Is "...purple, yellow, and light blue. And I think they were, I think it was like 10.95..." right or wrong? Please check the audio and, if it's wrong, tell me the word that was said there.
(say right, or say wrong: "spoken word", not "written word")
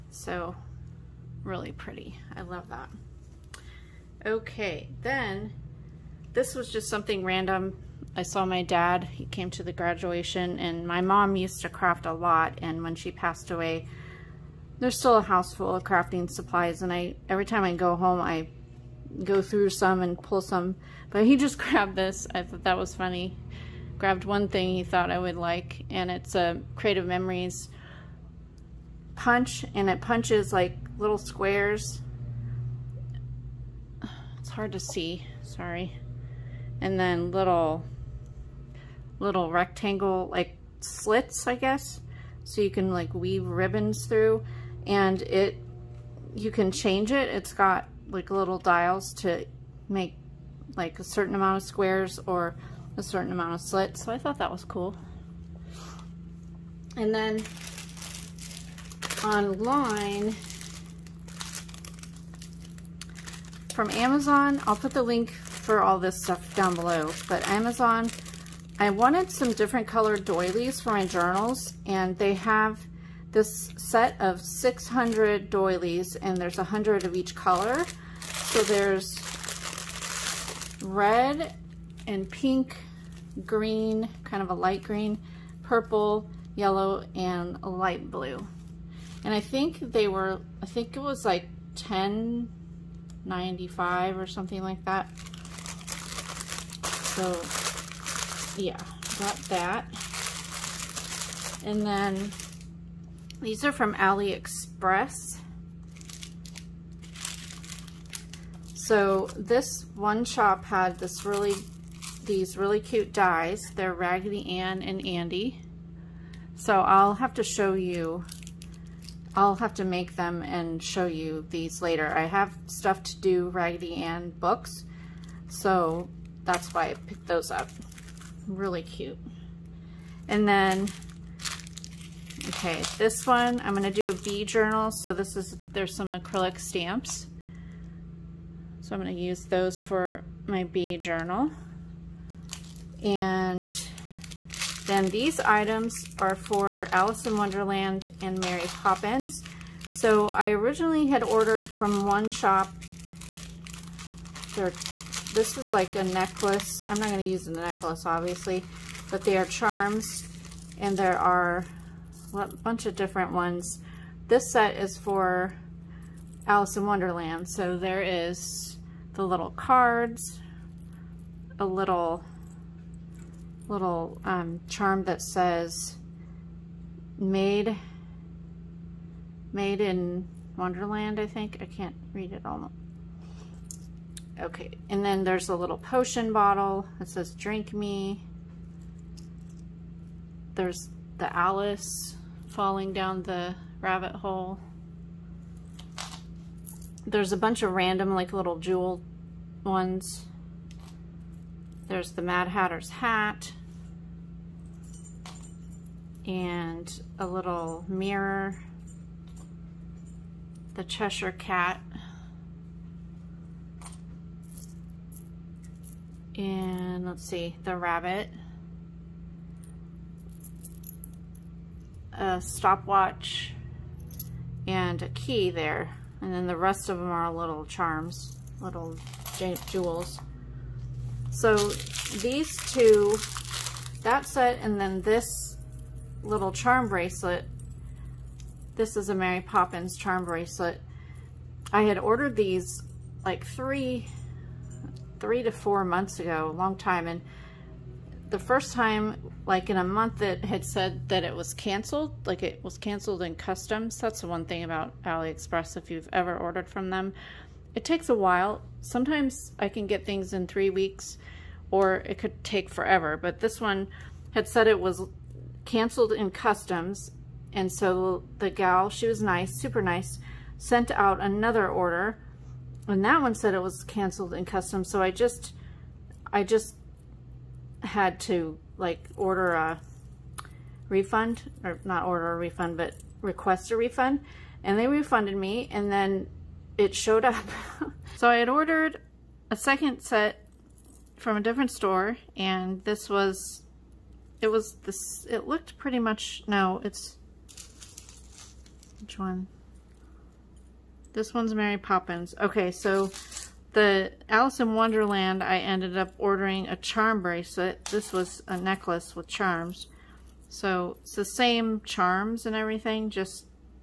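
right.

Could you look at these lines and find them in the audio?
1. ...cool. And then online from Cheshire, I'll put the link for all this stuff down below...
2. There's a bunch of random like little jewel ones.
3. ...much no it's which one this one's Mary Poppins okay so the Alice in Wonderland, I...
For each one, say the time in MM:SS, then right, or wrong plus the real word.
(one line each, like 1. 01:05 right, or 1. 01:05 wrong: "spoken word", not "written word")
1. 00:54 wrong: "Amazon", not "Cheshire"
2. 03:17 right
3. 04:55 right.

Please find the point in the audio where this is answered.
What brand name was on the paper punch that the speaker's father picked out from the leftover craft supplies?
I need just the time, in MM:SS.
00:26.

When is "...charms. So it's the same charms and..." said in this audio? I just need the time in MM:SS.
05:09.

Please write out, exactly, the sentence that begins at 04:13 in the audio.
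That's the one thing about AliExpress, if you've ever ordered from them.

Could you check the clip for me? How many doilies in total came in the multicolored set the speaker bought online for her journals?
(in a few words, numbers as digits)
600.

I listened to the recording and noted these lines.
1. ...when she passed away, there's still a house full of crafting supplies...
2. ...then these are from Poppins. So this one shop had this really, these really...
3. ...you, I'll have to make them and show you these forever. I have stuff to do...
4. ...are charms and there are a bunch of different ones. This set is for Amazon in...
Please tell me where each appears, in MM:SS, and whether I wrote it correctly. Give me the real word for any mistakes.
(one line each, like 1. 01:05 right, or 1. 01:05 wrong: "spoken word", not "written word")
1. 00:12 right
2. 01:41 wrong: "AliExpress", not "Poppins"
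3. 01:57 wrong: "later", not "forever"
4. 02:39 wrong: "Alice", not "Amazon".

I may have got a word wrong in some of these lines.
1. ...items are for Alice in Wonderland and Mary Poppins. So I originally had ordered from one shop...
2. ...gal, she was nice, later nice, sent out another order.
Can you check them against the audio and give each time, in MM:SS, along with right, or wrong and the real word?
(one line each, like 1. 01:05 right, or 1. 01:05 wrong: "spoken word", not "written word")
1. 02:25 right
2. 04:28 wrong: "super", not "later".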